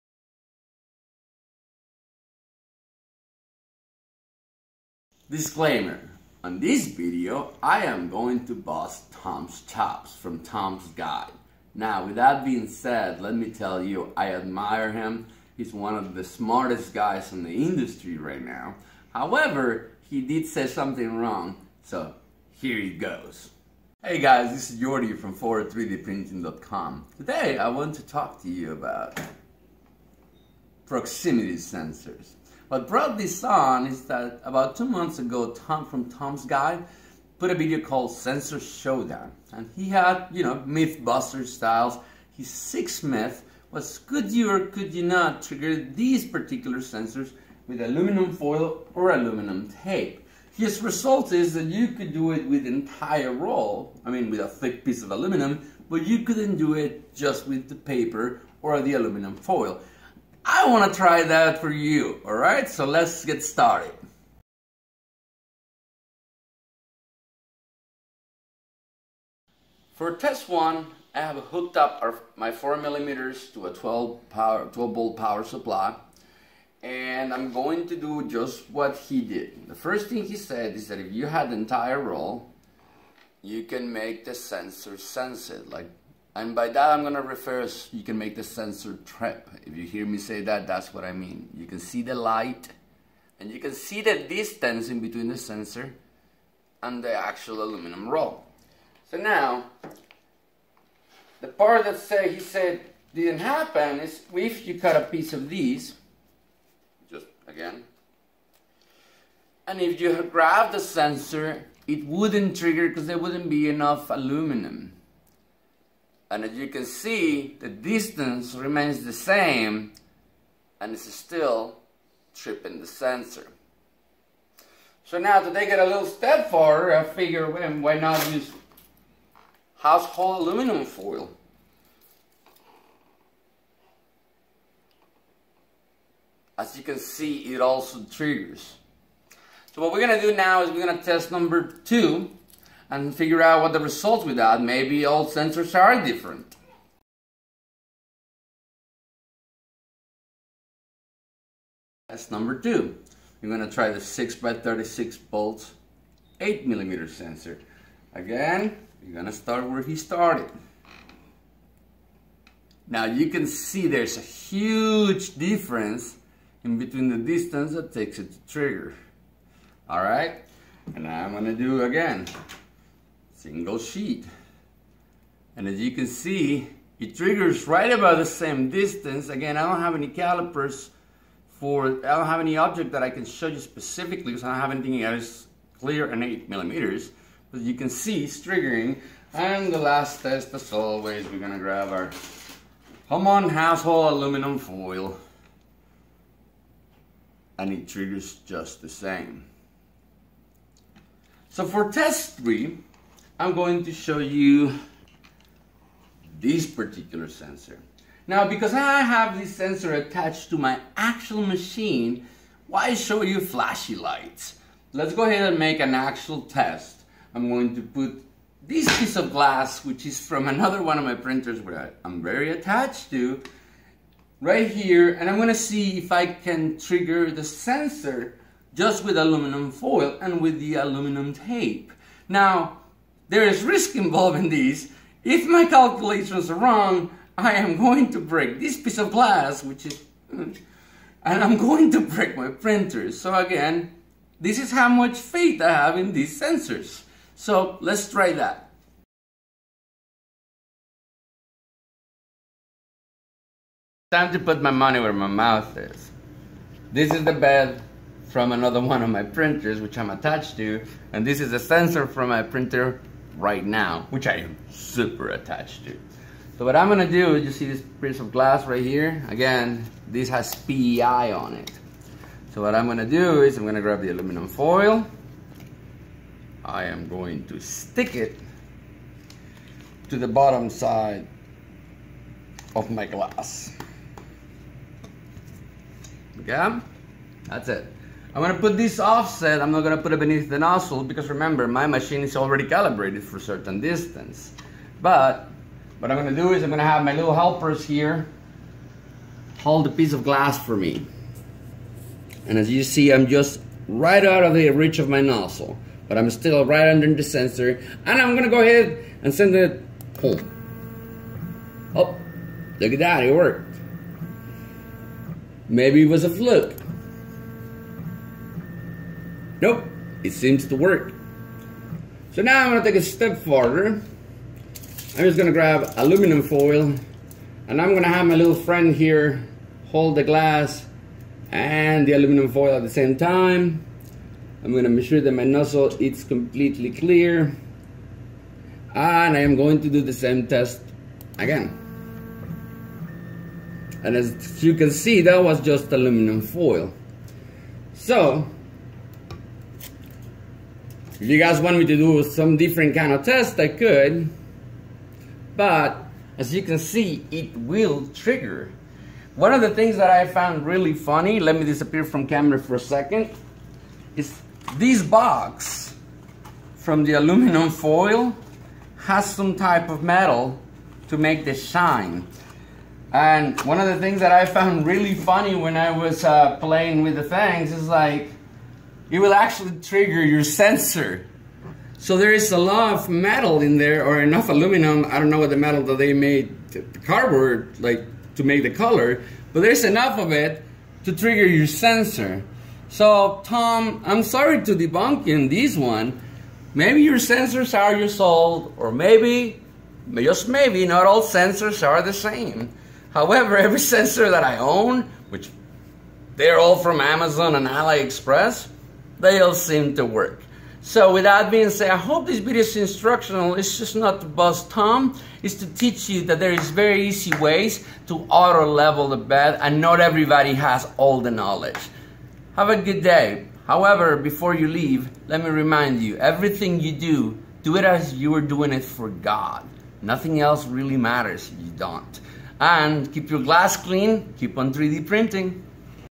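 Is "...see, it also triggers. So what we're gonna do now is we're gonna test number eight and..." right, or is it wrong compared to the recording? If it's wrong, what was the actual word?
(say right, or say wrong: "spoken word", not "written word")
wrong: "two", not "eight".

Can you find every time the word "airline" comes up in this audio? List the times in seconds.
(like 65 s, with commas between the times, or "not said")
not said.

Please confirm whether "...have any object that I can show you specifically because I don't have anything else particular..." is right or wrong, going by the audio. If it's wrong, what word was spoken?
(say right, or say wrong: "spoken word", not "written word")
wrong: "clear", not "particular".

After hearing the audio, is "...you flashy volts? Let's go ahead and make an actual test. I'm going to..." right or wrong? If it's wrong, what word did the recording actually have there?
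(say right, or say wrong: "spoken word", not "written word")
wrong: "lights", not "volts".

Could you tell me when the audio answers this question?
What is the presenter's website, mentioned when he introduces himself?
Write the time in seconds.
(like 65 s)
25 s.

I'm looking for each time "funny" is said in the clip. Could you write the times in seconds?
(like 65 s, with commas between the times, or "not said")
360 s, 375 s.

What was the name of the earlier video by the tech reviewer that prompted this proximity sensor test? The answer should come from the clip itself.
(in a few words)
Sensor Showdown.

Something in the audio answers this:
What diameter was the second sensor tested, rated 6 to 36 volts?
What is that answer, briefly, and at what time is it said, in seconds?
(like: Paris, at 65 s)
8 millimeters, at 156 s.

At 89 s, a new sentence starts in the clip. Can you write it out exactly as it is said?
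If you hear me say that, that's what I mean.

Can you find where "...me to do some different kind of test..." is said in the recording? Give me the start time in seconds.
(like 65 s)
351 s.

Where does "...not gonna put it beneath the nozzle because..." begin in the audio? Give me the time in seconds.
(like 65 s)
289 s.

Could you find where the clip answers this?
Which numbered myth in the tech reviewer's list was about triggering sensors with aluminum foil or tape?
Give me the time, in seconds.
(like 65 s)
42 s.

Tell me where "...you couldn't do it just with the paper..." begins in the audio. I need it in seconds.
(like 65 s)
56 s.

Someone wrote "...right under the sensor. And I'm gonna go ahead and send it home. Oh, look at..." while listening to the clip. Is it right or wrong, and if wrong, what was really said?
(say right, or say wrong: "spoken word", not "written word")
right.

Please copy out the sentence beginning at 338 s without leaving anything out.
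And I am going to do the same test again.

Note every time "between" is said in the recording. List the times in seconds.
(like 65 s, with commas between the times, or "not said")
95 s, 166 s.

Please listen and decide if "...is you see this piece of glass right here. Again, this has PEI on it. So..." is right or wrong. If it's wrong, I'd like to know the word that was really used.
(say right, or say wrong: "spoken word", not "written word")
right.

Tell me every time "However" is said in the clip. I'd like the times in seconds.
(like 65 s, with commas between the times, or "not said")
19 s, 403 s, 423 s.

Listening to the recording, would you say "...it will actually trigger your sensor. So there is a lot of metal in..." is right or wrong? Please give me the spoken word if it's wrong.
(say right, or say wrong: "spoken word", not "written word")
right.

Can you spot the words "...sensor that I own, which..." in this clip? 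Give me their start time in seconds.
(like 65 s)
403 s.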